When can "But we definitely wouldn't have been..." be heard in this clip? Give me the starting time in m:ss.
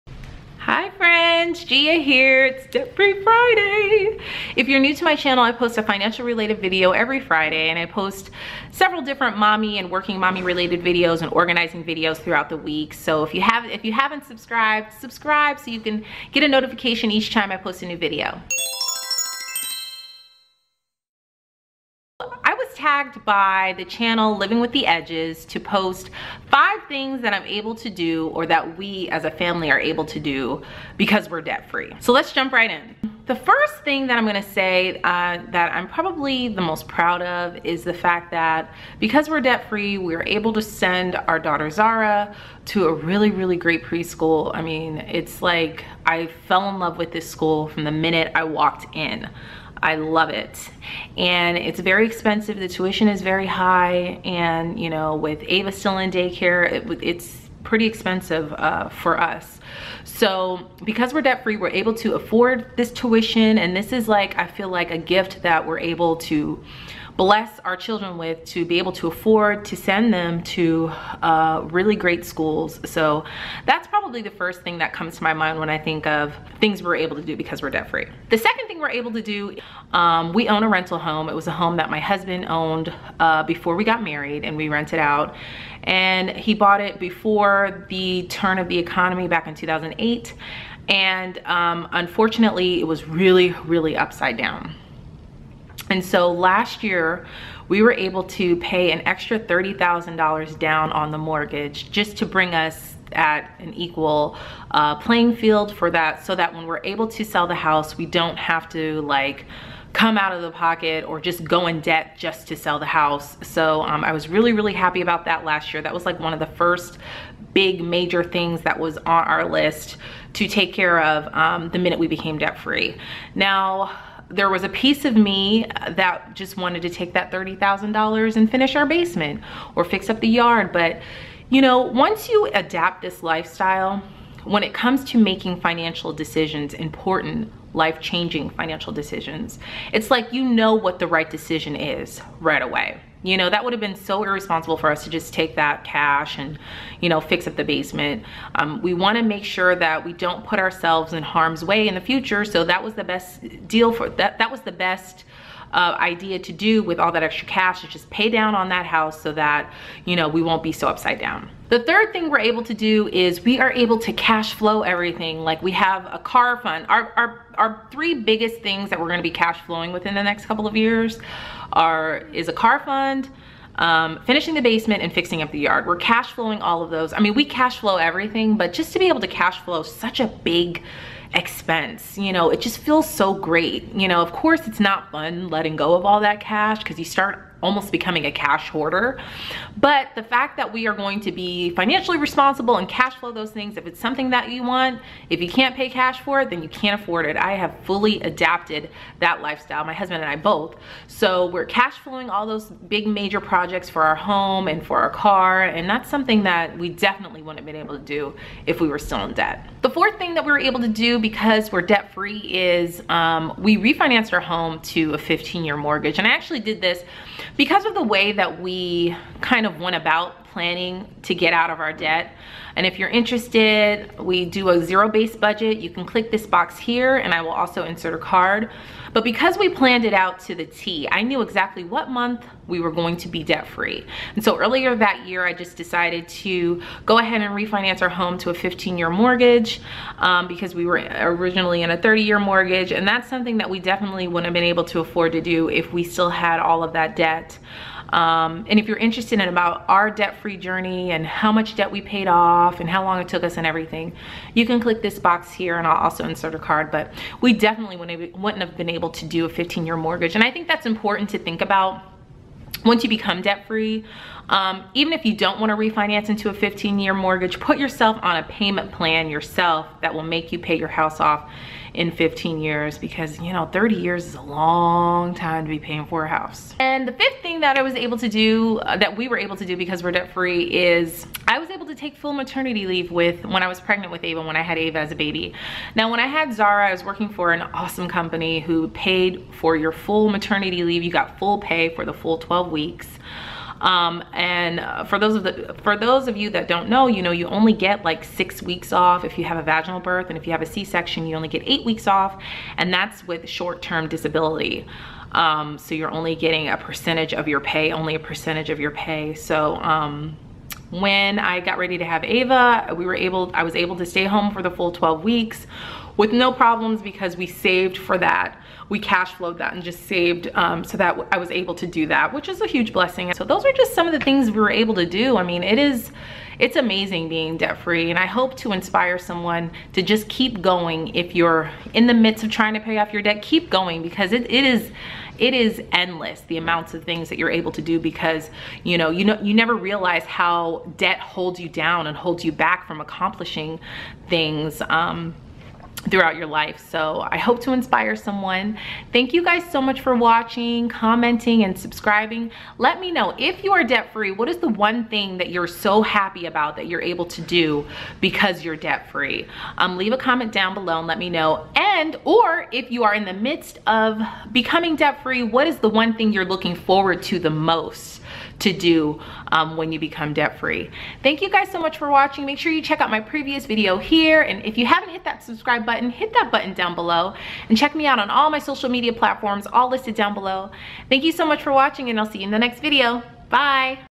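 4:16.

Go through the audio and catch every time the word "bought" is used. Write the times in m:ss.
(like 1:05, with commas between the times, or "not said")
1:26.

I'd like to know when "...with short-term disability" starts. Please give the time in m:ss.
5:03.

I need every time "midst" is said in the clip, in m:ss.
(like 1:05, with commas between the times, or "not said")
5:32, 6:03.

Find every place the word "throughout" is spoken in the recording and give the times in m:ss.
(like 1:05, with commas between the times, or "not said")
0:12, 5:46.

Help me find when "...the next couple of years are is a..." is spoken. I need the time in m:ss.
2:50.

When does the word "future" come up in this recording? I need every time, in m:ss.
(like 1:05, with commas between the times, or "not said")
2:32.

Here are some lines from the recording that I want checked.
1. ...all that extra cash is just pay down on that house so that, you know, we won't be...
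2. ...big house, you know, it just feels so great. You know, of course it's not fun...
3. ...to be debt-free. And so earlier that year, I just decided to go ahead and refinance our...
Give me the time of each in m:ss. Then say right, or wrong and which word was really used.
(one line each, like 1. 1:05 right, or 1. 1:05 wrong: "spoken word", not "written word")
1. 2:36 right
2. 3:00 wrong: "expense", not "house"
3. 3:53 right.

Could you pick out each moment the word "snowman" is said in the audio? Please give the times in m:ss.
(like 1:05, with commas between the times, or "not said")
not said.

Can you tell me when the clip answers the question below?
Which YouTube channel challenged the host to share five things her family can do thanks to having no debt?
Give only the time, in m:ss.
0:24.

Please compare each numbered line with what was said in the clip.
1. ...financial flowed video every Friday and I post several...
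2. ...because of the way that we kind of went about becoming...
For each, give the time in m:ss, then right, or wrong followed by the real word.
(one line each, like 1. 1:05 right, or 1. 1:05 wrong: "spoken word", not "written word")
1. 0:05 wrong: "related", not "flowed"
2. 3:37 wrong: "planning", not "becoming".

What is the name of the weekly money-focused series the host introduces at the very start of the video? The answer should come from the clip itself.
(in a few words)
Debt Free Friday.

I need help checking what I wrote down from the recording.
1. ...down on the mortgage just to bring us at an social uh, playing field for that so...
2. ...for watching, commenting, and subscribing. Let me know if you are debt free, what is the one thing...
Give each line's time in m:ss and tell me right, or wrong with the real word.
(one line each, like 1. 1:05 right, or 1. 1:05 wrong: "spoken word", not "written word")
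1. 1:40 wrong: "equal", not "social"
2. 5:50 right.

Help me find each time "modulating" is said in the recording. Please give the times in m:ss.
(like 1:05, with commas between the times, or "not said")
not said.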